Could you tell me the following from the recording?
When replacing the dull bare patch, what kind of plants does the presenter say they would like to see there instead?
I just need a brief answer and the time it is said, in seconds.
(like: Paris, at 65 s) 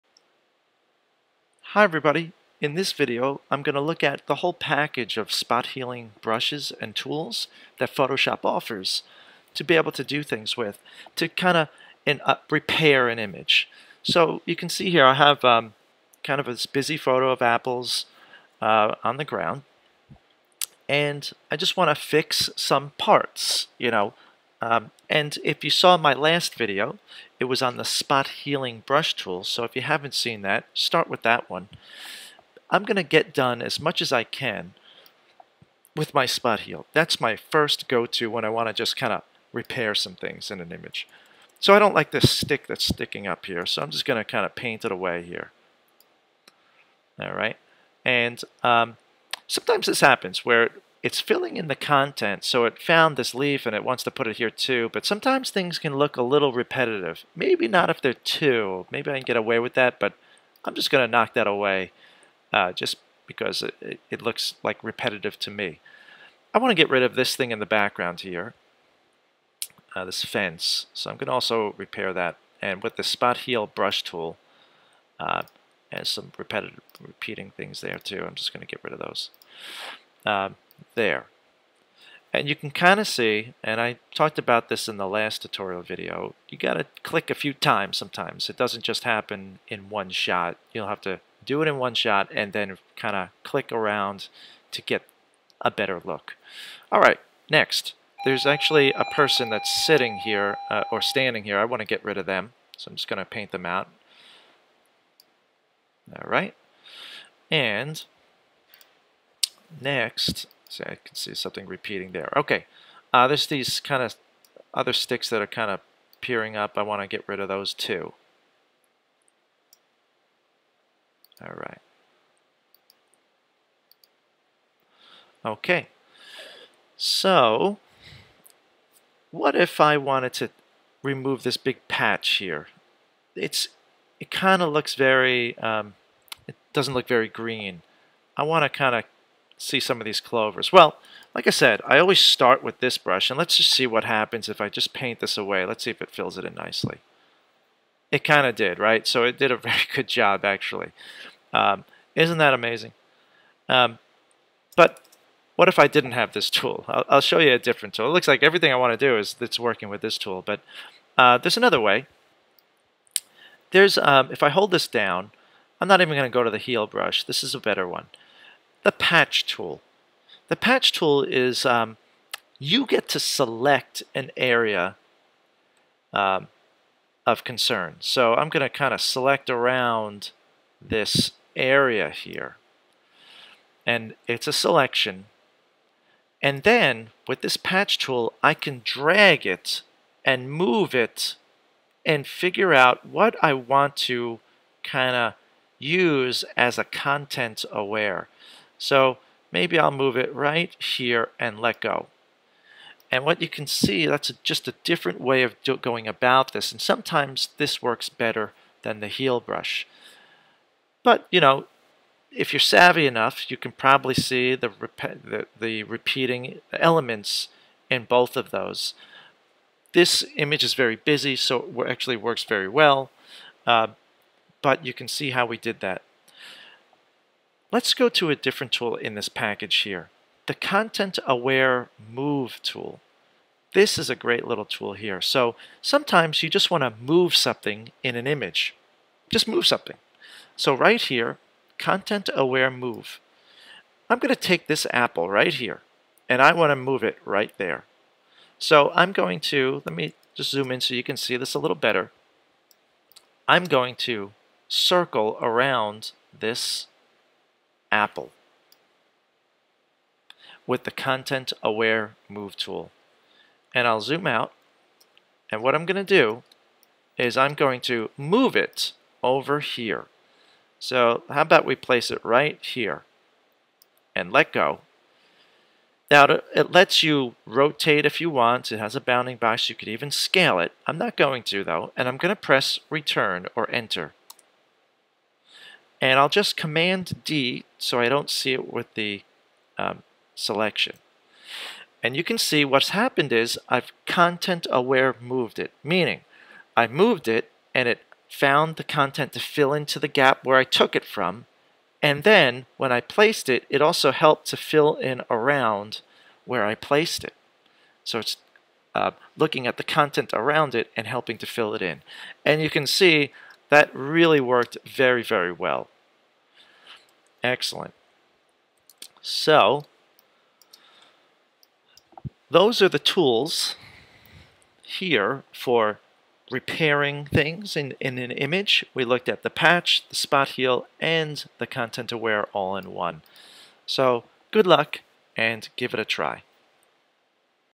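clovers, at 140 s.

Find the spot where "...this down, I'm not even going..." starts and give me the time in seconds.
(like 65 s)
164 s.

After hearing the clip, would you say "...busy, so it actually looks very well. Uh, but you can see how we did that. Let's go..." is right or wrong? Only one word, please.
wrong.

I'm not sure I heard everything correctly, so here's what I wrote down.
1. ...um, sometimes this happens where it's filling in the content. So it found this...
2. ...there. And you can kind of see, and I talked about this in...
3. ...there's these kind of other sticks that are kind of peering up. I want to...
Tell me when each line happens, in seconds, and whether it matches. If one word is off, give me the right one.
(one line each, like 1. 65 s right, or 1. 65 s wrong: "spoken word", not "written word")
1. 48 s right
2. 80 s right
3. 113 s right.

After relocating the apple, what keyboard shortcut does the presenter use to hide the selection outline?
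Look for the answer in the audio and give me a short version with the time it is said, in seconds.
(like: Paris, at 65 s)
Command D, at 286 s.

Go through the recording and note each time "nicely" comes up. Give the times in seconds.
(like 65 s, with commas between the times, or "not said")
146 s.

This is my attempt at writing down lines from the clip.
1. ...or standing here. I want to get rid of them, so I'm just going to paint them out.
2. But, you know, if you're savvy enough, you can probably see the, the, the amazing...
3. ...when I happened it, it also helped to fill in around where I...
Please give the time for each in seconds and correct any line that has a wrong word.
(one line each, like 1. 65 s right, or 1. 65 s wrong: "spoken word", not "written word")
1. 100 s right
2. 211 s wrong: "repeating", not "amazing"
3. 302 s wrong: "placed", not "happened".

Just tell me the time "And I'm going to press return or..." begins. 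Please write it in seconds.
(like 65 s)
281 s.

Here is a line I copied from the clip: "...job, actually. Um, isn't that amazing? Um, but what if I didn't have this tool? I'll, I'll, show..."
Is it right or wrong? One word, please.
right.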